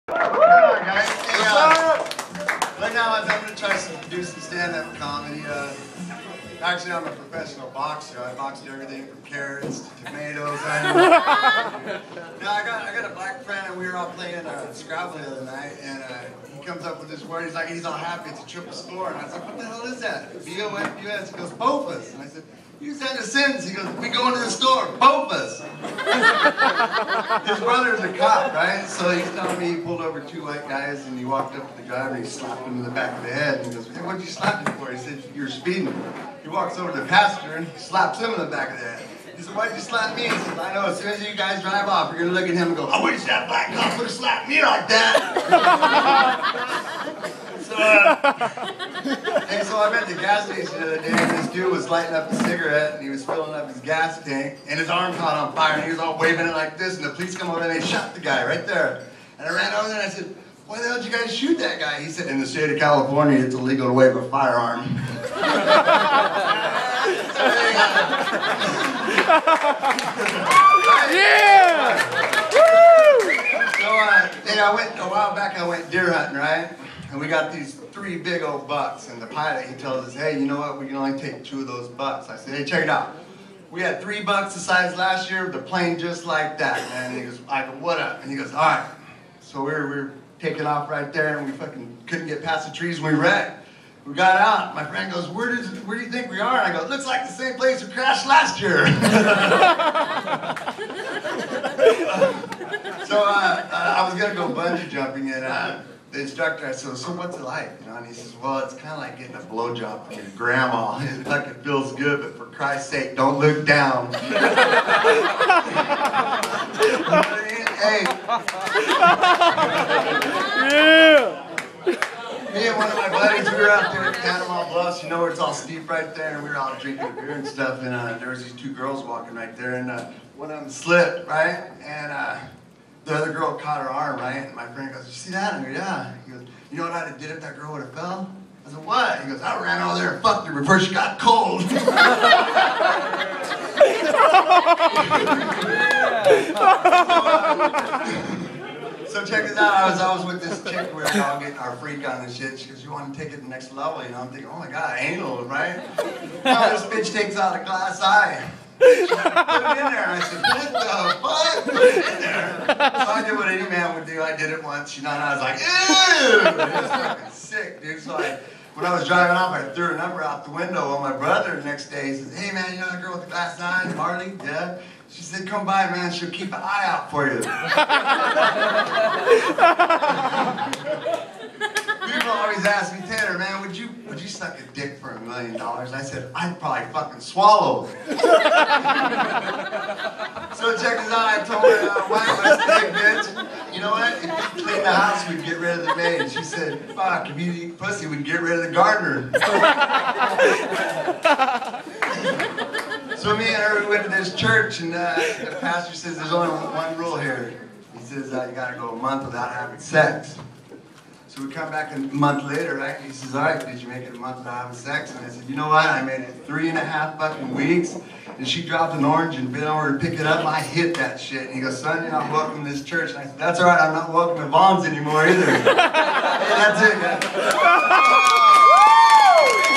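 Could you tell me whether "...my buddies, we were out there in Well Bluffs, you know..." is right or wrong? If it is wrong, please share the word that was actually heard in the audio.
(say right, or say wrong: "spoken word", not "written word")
wrong: "Panorama", not "Well".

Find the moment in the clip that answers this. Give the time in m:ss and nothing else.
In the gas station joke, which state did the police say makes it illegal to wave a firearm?
1:02.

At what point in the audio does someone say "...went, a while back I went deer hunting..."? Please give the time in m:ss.
1:14.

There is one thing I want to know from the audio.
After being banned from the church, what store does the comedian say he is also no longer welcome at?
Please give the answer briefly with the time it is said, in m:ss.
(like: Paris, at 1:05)
Vons, at 3:44.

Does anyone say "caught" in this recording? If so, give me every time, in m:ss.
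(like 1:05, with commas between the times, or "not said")
0:55, 2:13.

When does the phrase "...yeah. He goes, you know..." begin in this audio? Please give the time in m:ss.
2:15.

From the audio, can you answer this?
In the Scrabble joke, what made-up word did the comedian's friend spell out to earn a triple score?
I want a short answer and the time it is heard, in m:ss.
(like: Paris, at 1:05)
Bofus, at 0:21.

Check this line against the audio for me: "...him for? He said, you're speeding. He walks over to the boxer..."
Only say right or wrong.
wrong.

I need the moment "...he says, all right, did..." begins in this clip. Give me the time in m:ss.
3:33.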